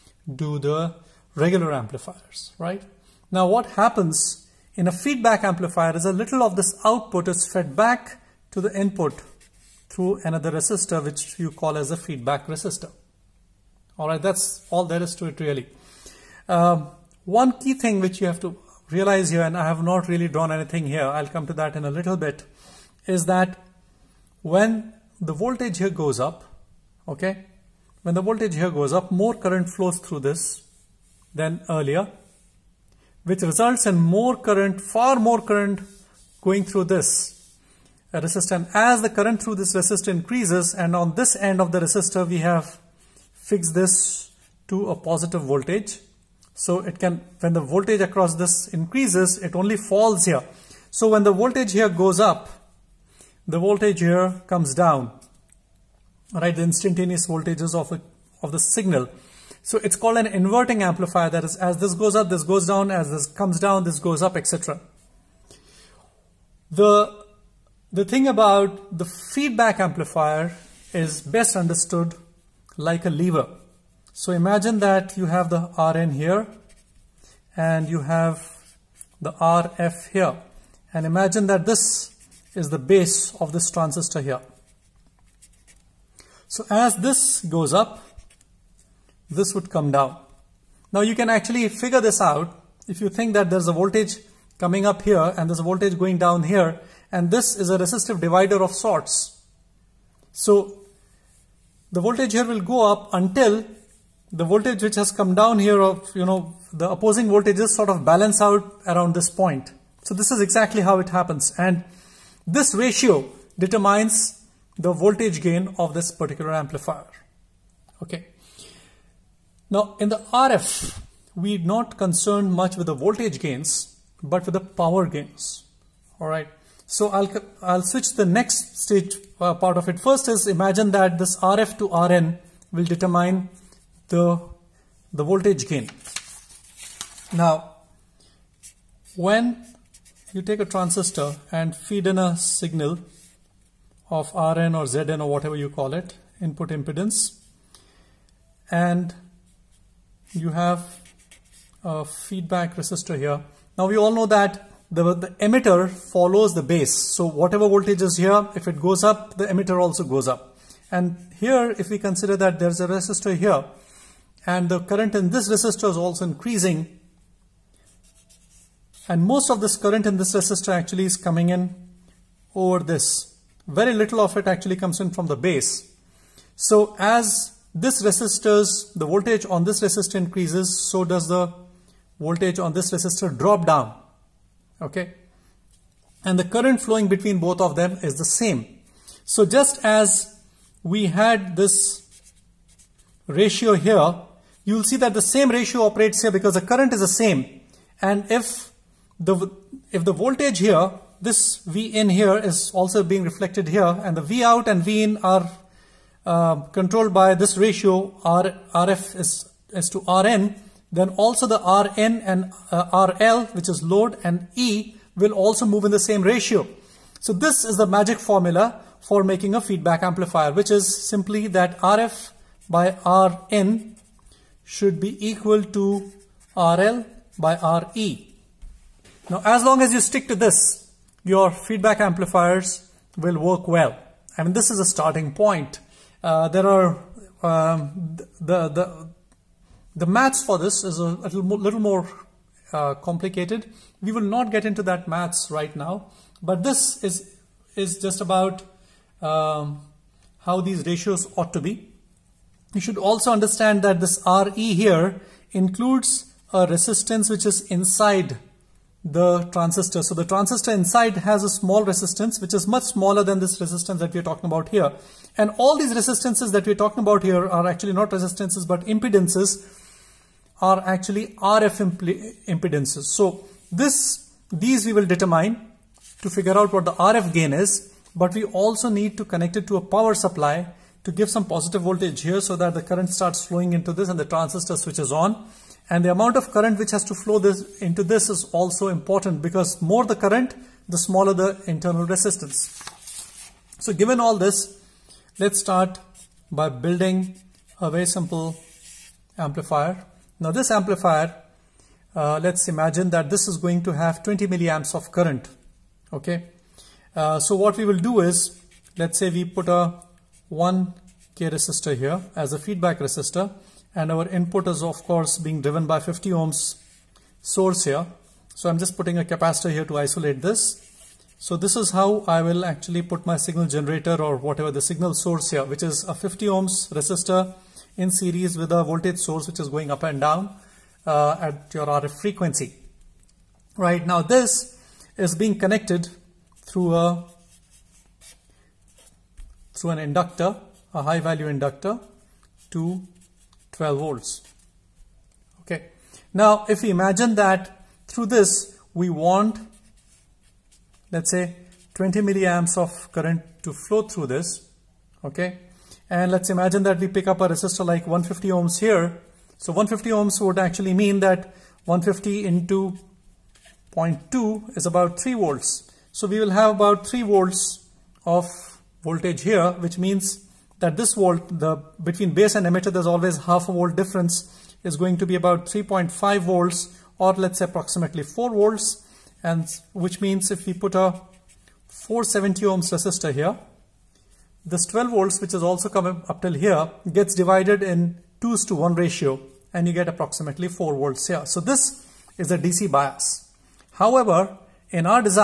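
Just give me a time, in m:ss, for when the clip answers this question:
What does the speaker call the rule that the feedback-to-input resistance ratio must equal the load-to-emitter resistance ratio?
3:37.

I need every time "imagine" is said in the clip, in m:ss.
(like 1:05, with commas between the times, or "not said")
1:14, 1:21, 2:10, 5:02, 5:46, 5:56.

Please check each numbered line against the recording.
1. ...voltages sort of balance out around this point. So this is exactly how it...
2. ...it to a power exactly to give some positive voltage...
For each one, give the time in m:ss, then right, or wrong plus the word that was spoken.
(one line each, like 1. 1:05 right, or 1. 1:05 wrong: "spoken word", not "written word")
1. 1:47 right
2. 4:39 wrong: "supply", not "exactly".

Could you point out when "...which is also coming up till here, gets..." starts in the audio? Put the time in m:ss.
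6:25.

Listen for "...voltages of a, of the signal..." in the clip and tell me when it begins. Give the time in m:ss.
0:57.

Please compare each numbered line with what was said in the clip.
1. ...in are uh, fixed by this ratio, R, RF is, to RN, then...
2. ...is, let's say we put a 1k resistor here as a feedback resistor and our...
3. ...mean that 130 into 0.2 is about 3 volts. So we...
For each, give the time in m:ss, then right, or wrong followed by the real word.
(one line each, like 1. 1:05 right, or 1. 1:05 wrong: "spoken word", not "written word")
1. 3:25 wrong: "controlled", not "fixed"
2. 5:08 right
3. 6:00 wrong: "150", not "130".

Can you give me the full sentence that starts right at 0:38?
as the current through this resistor increases, and on this end of the resistor, we have fixed this to a positive voltage.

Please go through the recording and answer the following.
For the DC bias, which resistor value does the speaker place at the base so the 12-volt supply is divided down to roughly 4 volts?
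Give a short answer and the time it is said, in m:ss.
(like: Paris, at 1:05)
470 ohms, at 6:21.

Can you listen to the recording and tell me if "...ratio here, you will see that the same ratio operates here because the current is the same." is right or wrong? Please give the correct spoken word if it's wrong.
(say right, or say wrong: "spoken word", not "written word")
right.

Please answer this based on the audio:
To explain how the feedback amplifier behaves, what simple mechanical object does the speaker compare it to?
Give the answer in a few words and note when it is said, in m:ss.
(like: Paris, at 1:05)
a lever, at 1:13.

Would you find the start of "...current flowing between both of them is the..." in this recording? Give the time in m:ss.
3:06.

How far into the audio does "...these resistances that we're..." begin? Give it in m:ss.
4:25.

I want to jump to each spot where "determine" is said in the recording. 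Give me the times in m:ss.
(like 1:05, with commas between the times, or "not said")
1:53, 2:12, 4:35.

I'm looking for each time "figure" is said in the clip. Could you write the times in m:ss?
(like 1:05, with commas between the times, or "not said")
1:31, 4:36.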